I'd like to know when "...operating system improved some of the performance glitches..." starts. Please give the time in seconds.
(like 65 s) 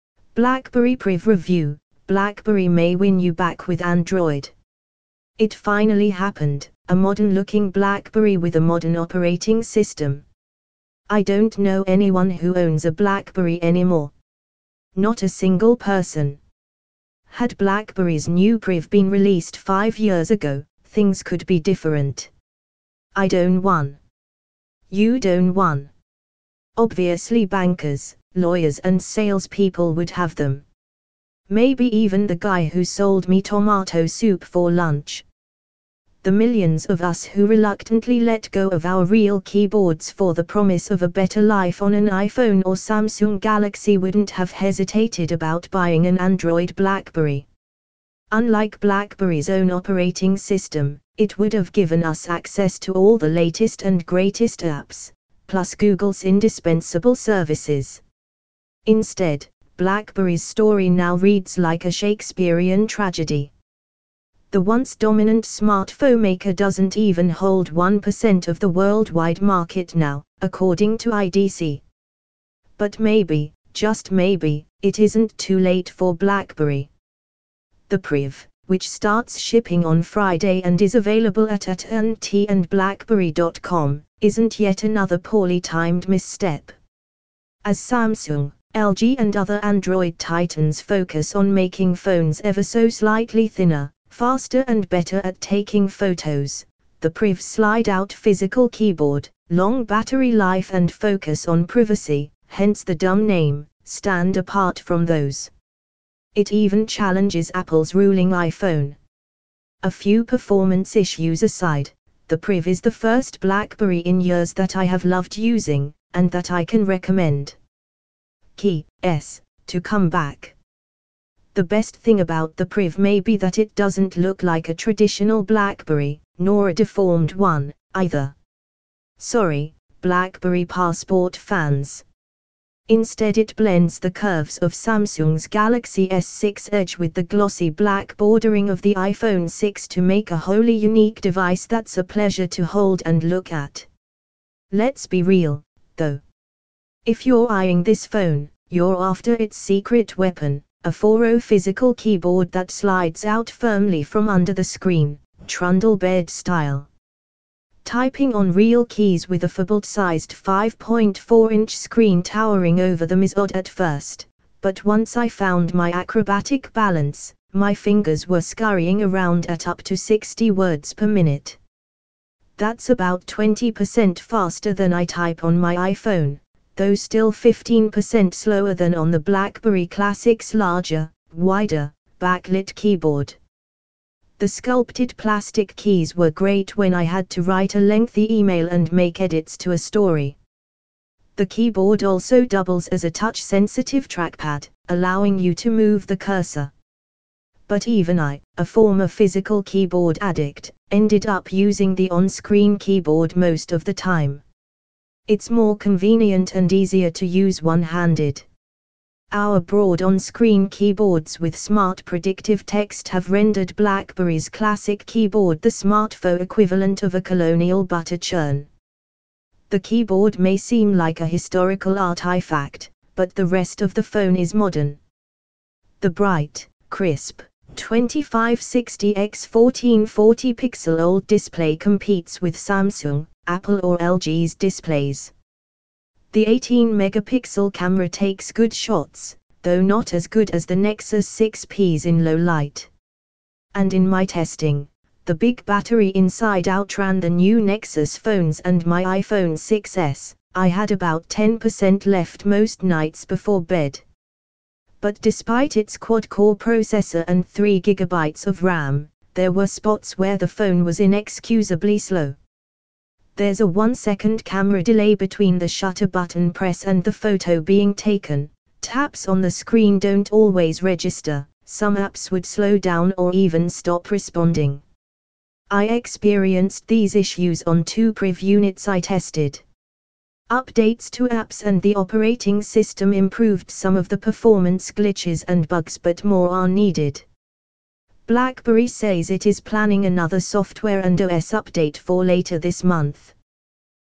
281 s.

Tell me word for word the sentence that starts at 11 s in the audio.
I don't know anyone who owns a BlackBerry anymore.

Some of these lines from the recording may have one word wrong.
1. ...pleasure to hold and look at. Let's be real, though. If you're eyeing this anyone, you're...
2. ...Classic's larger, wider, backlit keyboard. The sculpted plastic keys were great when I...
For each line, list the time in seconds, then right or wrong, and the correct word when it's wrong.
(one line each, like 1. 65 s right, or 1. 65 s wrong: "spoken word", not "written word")
1. 142 s wrong: "phone", not "anyone"
2. 179 s right.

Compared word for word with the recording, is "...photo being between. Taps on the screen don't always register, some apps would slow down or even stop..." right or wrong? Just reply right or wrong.
wrong.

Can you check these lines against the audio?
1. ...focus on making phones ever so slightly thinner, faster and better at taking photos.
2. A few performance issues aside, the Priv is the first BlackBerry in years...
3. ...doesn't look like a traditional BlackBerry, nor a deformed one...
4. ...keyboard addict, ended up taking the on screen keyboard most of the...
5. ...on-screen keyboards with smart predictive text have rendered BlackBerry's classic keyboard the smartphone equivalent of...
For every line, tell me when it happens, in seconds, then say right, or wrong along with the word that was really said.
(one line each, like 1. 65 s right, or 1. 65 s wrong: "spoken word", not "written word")
1. 90 s right
2. 109 s right
3. 123 s right
4. 199 s wrong: "using", not "taking"
5. 210 s right.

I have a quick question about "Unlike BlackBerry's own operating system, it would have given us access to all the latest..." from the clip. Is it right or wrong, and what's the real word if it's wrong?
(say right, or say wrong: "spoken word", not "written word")
right.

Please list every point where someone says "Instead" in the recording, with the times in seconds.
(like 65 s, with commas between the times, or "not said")
58 s, 132 s.